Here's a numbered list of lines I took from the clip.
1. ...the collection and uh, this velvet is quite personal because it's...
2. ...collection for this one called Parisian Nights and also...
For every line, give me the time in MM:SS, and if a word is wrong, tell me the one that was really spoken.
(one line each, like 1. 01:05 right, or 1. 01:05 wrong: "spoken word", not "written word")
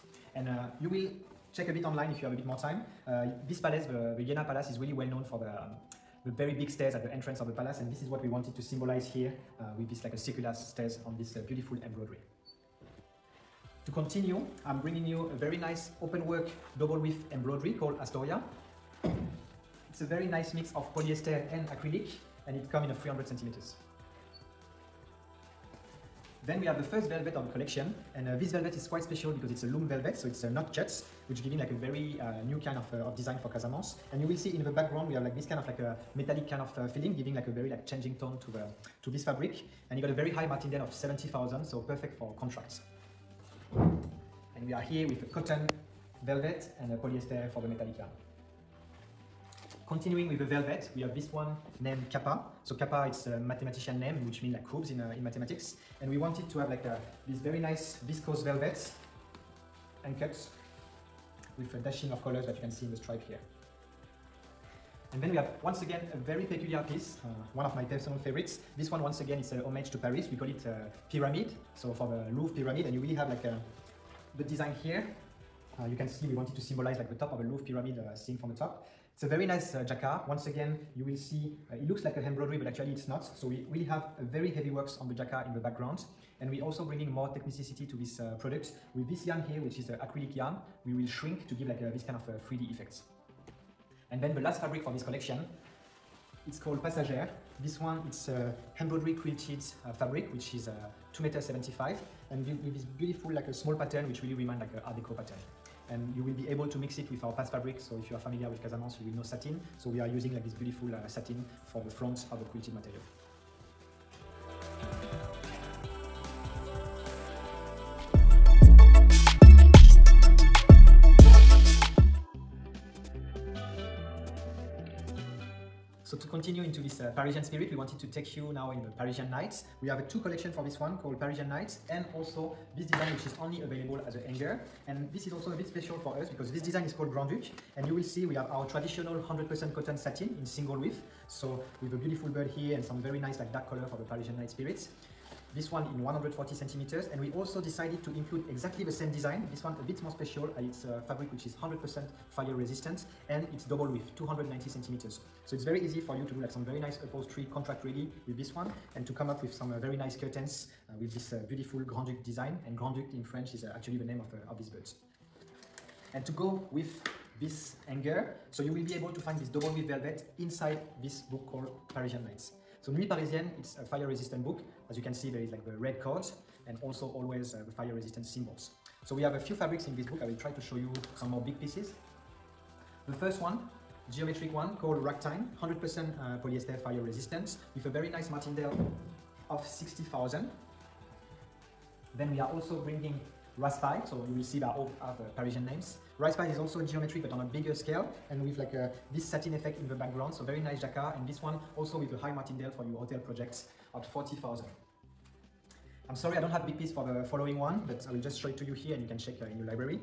1. 00:27 wrong: "special", not "personal"
2. 02:10 right.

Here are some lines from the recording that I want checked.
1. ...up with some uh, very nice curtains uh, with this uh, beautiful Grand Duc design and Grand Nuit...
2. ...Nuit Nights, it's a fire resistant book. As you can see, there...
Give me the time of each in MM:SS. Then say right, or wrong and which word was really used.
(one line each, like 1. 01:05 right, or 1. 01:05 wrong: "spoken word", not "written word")
1. 02:39 wrong: "Duc", not "Nuit"
2. 02:52 wrong: "Parisienne", not "Nights".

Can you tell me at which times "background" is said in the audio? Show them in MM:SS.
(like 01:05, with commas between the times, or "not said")
00:34, 01:25, 03:19.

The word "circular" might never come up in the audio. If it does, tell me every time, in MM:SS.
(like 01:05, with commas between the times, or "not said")
00:10.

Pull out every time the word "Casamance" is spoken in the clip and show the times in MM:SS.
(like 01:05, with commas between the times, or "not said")
00:33, 01:48.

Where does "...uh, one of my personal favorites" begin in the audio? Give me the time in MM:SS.
01:07.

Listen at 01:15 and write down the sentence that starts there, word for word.
Uh, you can see we wanted to symbolize like the top of a Louvre pyramid uh, seen from the top.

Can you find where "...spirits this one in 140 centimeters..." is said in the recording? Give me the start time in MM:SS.
02:24.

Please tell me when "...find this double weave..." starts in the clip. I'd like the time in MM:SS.
02:49.